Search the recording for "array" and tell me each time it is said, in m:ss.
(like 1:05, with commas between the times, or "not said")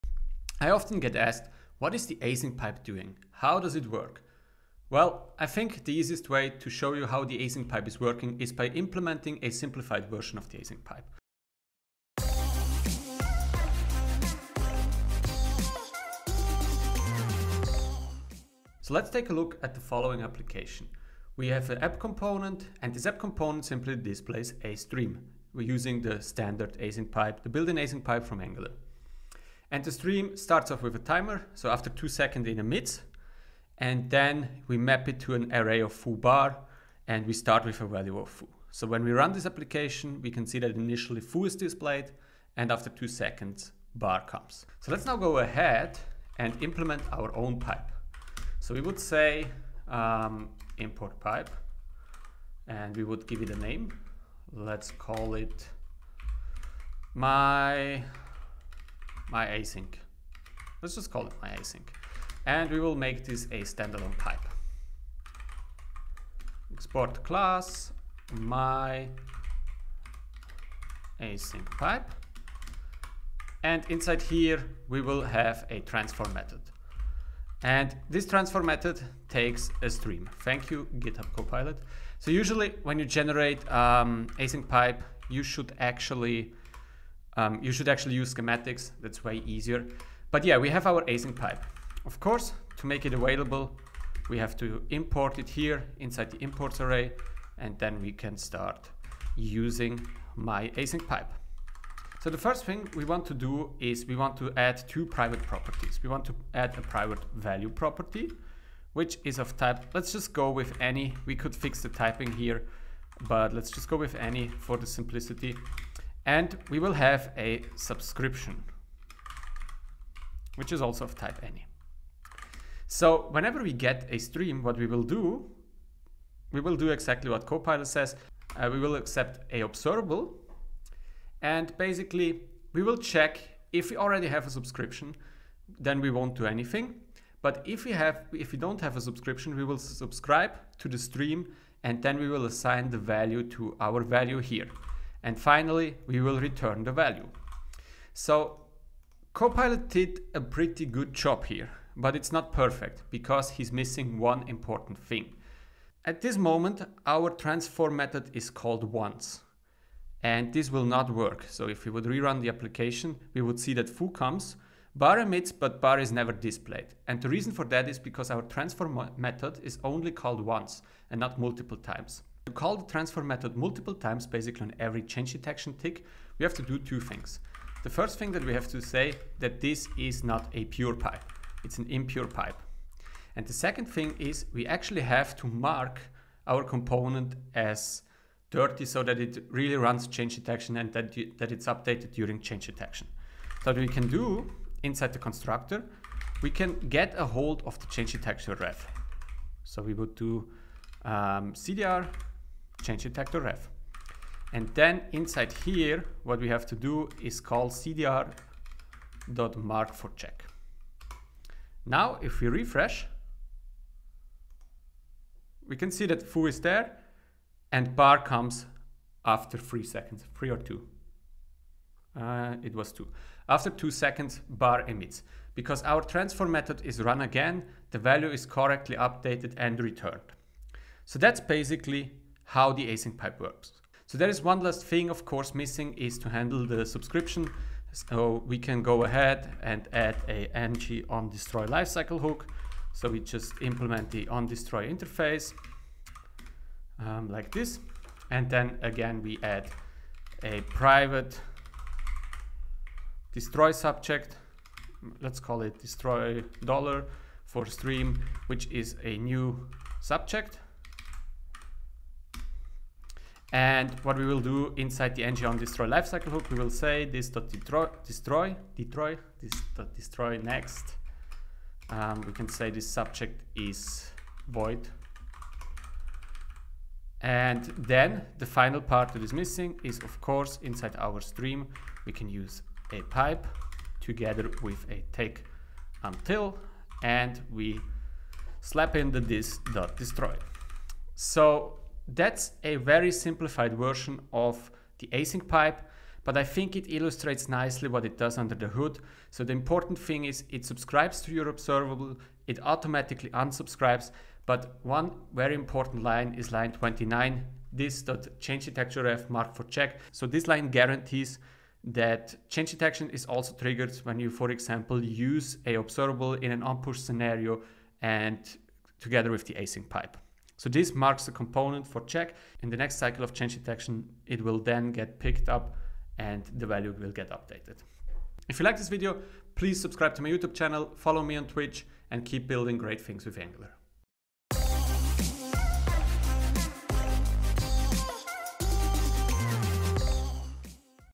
0:35, 1:36.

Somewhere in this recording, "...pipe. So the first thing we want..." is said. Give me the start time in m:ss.
1:41.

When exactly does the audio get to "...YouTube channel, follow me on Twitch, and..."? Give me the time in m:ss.
5:30.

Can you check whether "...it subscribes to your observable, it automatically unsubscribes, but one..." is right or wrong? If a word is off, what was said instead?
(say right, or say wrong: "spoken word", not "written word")
right.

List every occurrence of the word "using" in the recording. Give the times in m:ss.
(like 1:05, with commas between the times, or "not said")
0:25, 1:39.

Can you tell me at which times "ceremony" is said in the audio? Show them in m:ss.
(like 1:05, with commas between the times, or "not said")
not said.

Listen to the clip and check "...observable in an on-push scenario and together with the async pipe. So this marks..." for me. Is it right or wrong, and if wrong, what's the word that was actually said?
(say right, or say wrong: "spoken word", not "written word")
right.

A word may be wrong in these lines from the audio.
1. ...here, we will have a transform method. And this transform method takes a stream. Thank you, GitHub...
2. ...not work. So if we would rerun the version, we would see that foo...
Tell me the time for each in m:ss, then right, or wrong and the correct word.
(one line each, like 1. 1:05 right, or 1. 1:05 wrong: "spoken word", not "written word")
1. 1:14 right
2. 2:40 wrong: "application", not "version".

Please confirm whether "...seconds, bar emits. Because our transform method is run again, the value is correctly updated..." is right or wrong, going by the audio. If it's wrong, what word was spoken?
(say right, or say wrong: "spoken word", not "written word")
right.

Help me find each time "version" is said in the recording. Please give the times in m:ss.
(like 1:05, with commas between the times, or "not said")
0:10, 4:53.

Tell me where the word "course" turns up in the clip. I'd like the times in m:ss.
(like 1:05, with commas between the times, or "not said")
1:32, 3:55, 4:40.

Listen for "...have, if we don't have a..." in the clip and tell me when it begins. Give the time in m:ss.
2:17.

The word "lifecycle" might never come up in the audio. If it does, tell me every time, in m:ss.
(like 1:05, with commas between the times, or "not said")
4:01, 4:25.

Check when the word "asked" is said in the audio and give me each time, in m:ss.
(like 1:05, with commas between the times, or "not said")
0:01.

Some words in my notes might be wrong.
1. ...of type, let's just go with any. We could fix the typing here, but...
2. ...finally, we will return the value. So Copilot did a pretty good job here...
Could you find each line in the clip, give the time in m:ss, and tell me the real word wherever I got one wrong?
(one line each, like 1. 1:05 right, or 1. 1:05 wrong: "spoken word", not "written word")
1. 1:49 right
2. 2:25 right.